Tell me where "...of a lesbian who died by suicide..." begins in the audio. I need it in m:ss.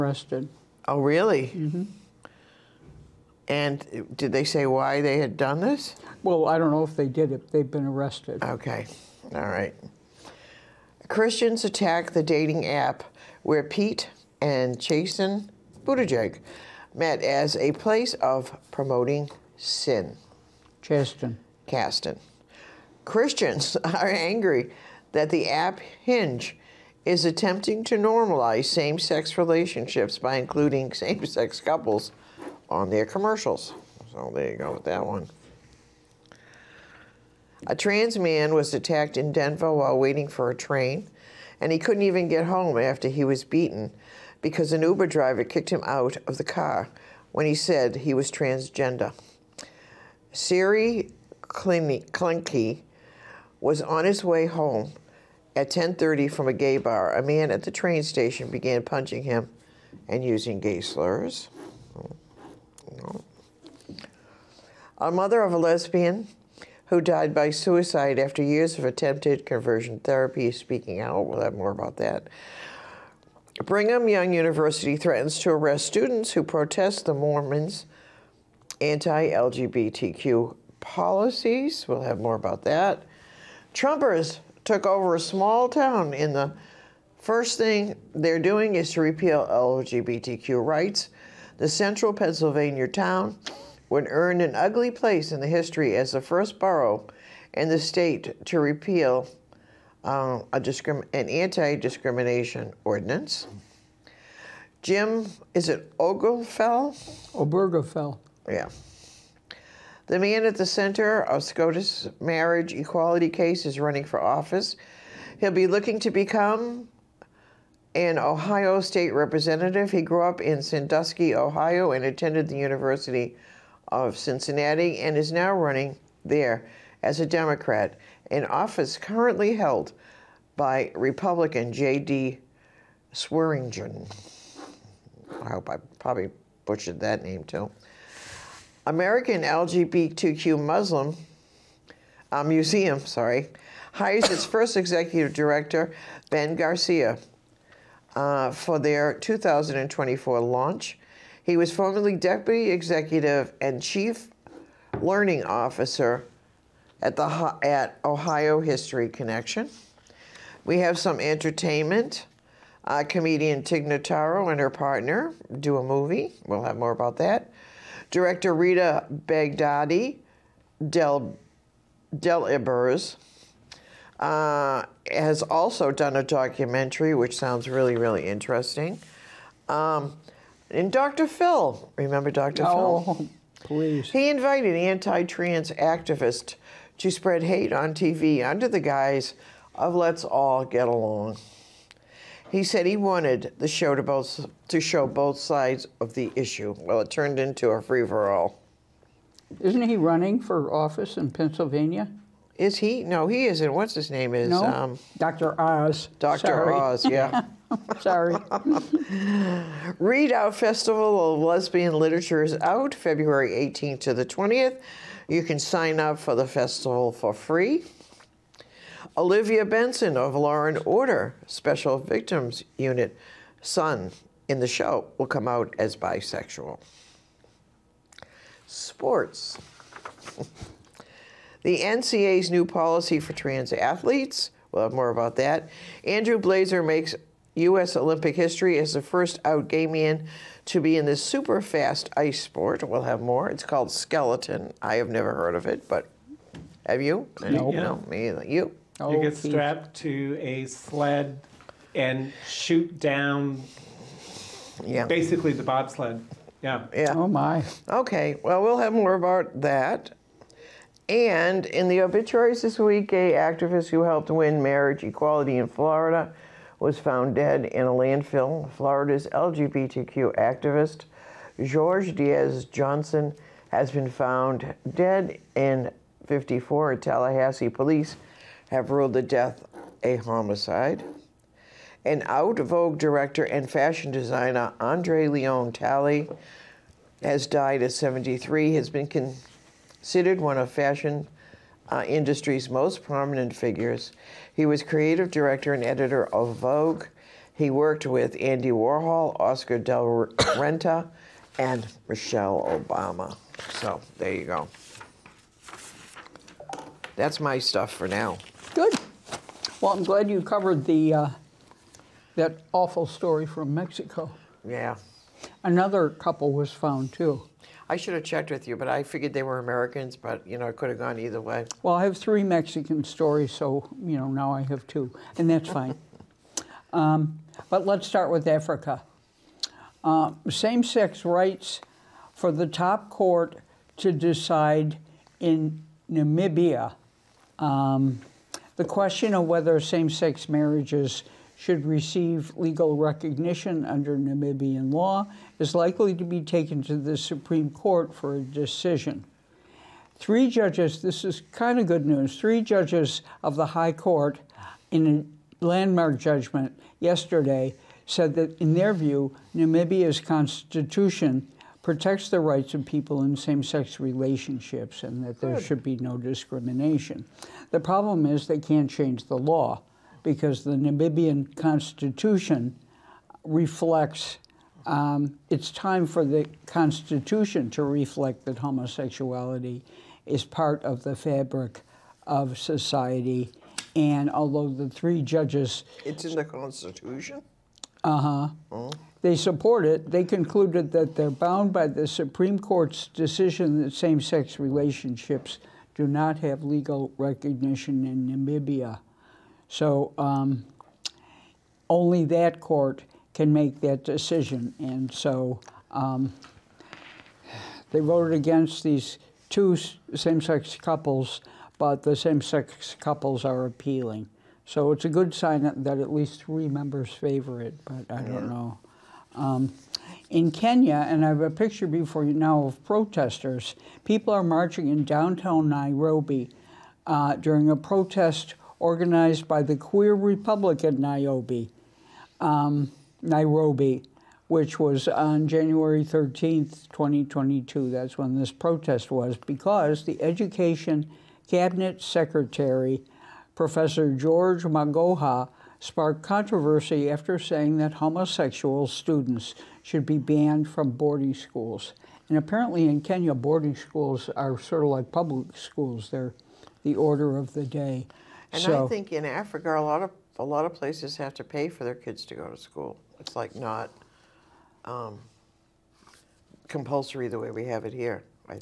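1:05.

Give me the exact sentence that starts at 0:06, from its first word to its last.
Well, I don't know if they did it.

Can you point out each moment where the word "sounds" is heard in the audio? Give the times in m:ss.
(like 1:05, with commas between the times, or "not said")
2:57.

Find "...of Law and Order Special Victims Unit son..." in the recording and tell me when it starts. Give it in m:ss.
3:40.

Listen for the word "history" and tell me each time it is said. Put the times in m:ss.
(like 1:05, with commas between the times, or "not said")
1:35, 2:38, 3:58.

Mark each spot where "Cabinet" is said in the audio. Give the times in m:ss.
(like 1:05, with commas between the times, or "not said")
7:21.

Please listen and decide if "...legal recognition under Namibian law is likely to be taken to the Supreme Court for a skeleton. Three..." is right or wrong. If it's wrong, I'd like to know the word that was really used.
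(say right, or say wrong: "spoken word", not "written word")
wrong: "decision", not "skeleton".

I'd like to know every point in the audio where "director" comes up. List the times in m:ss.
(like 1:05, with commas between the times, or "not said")
2:25, 2:48, 4:42, 4:55.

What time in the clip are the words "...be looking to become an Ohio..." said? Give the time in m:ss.
1:55.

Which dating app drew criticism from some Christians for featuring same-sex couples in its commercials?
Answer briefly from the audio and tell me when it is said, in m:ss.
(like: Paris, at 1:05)
Hinge, at 0:26.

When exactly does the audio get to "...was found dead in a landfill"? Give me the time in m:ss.
4:26.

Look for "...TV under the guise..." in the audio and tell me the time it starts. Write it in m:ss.
3:07.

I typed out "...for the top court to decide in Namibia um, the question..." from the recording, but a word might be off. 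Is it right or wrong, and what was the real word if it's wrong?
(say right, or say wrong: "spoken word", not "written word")
right.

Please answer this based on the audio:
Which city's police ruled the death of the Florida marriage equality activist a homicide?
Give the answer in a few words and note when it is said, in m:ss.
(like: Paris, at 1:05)
Tallahassee, at 4:36.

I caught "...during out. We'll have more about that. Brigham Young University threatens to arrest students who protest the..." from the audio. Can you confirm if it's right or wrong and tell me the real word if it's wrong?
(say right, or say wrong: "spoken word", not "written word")
wrong: "speaking", not "during".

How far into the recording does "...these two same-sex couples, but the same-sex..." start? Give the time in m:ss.
6:48.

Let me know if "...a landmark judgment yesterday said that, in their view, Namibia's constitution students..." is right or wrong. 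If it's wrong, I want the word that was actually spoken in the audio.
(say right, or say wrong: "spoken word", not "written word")
wrong: "protects", not "students".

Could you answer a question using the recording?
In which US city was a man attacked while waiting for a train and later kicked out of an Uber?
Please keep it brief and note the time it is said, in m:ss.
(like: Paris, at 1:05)
Denver, at 0:39.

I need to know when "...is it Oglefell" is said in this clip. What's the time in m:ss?
1:45.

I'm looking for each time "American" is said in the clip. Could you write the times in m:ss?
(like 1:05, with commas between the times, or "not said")
2:18, 5:19.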